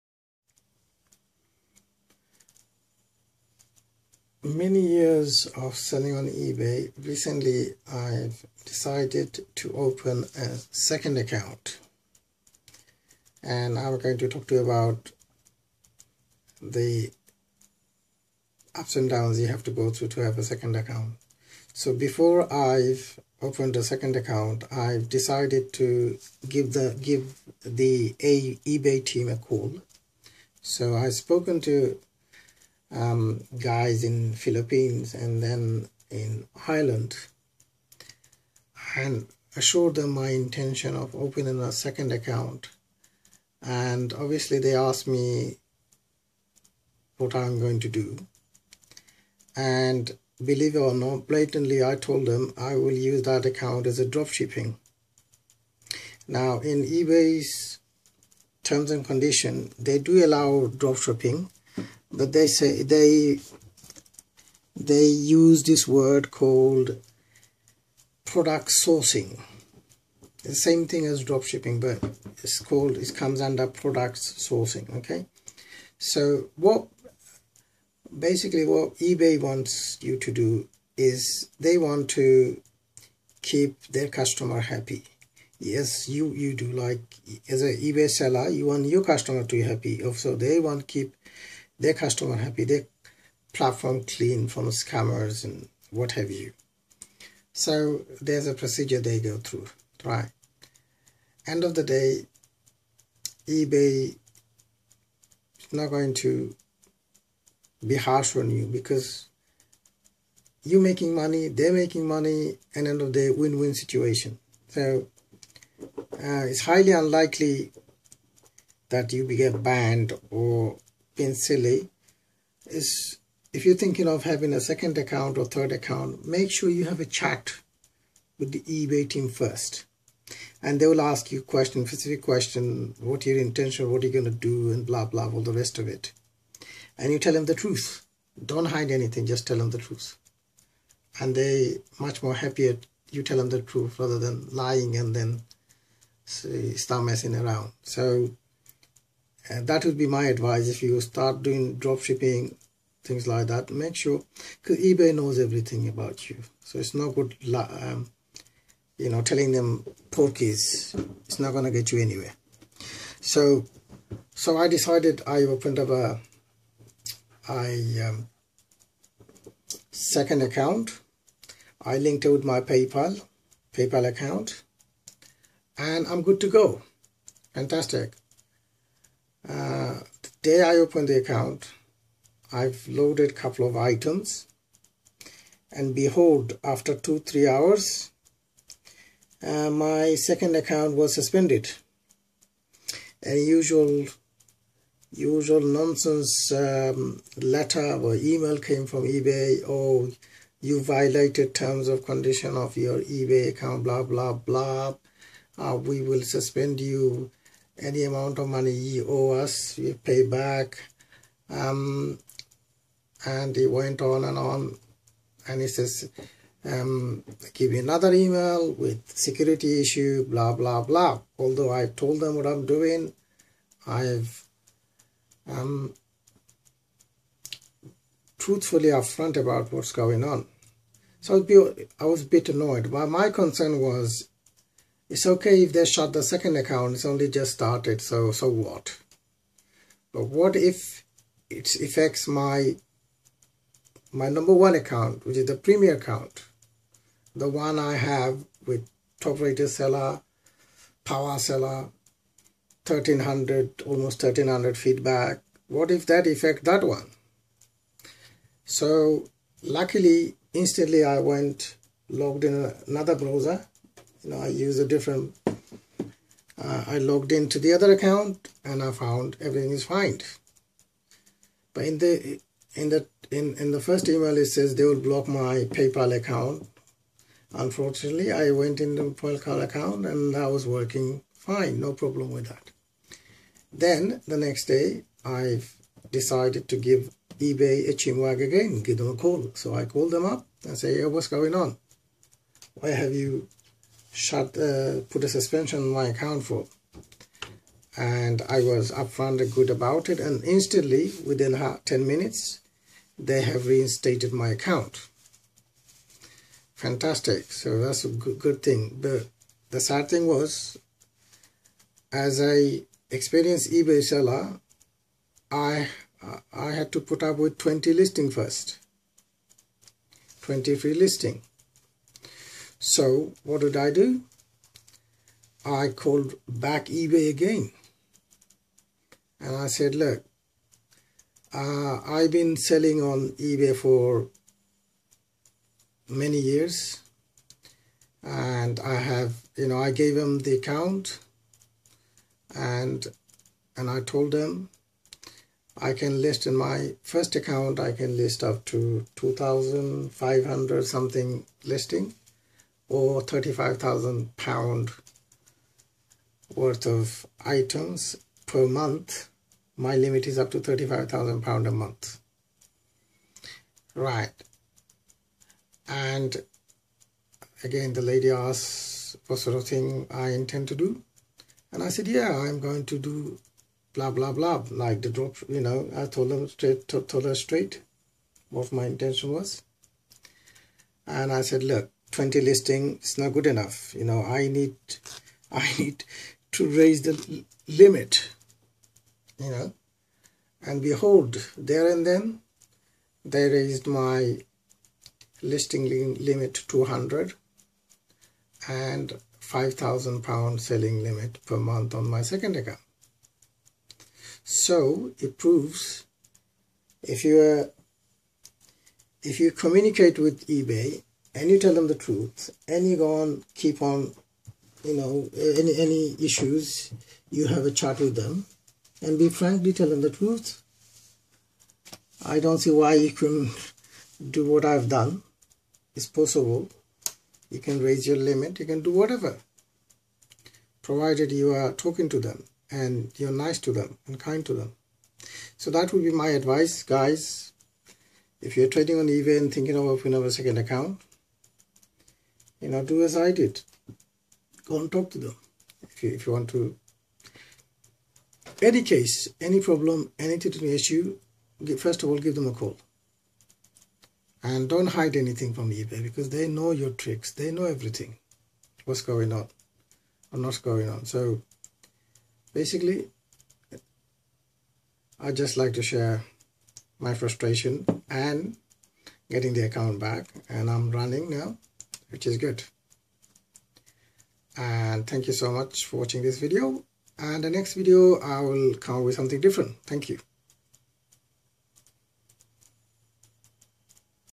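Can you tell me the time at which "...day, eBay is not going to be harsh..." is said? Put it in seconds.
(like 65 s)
101 s.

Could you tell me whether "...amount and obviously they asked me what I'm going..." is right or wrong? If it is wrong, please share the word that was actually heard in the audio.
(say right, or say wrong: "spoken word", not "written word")
wrong: "account", not "amount".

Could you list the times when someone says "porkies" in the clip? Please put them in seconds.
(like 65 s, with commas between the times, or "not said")
160 s.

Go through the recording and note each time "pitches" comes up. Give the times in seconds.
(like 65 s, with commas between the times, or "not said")
not said.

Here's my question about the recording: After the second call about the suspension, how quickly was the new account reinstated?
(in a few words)
10 minutes.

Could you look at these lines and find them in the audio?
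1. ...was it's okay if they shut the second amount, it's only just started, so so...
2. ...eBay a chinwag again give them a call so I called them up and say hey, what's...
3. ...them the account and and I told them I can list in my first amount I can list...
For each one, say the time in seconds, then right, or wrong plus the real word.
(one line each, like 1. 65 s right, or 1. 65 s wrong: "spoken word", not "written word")
1. 233 s wrong: "account", not "amount"
2. 287 s right
3. 340 s wrong: "account", not "amount".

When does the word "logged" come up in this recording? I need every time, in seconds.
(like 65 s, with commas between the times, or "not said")
262 s, 266 s.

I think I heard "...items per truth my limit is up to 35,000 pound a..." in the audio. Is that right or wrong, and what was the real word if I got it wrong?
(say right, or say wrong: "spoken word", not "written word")
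wrong: "month", not "truth".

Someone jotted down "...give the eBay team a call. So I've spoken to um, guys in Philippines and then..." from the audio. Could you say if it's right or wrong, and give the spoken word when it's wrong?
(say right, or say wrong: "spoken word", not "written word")
right.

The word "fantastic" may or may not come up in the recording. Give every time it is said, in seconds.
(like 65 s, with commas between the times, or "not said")
177 s, 306 s.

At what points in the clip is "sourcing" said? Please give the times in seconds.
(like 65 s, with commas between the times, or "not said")
68 s, 74 s.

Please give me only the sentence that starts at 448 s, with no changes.
Any case, any problem, any any issue, first of all, give them a call.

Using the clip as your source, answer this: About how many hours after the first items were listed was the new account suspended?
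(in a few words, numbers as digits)
two three hours.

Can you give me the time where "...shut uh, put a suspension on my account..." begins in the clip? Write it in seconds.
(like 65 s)
294 s.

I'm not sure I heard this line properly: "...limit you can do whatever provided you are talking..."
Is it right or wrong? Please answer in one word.
right.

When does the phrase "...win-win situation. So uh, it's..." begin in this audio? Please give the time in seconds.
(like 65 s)
113 s.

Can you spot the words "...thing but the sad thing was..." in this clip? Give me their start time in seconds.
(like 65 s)
308 s.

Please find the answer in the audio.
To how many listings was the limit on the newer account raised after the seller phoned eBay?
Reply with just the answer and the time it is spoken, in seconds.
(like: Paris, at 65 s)
200, at 396 s.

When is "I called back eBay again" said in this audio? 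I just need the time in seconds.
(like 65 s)
325 s.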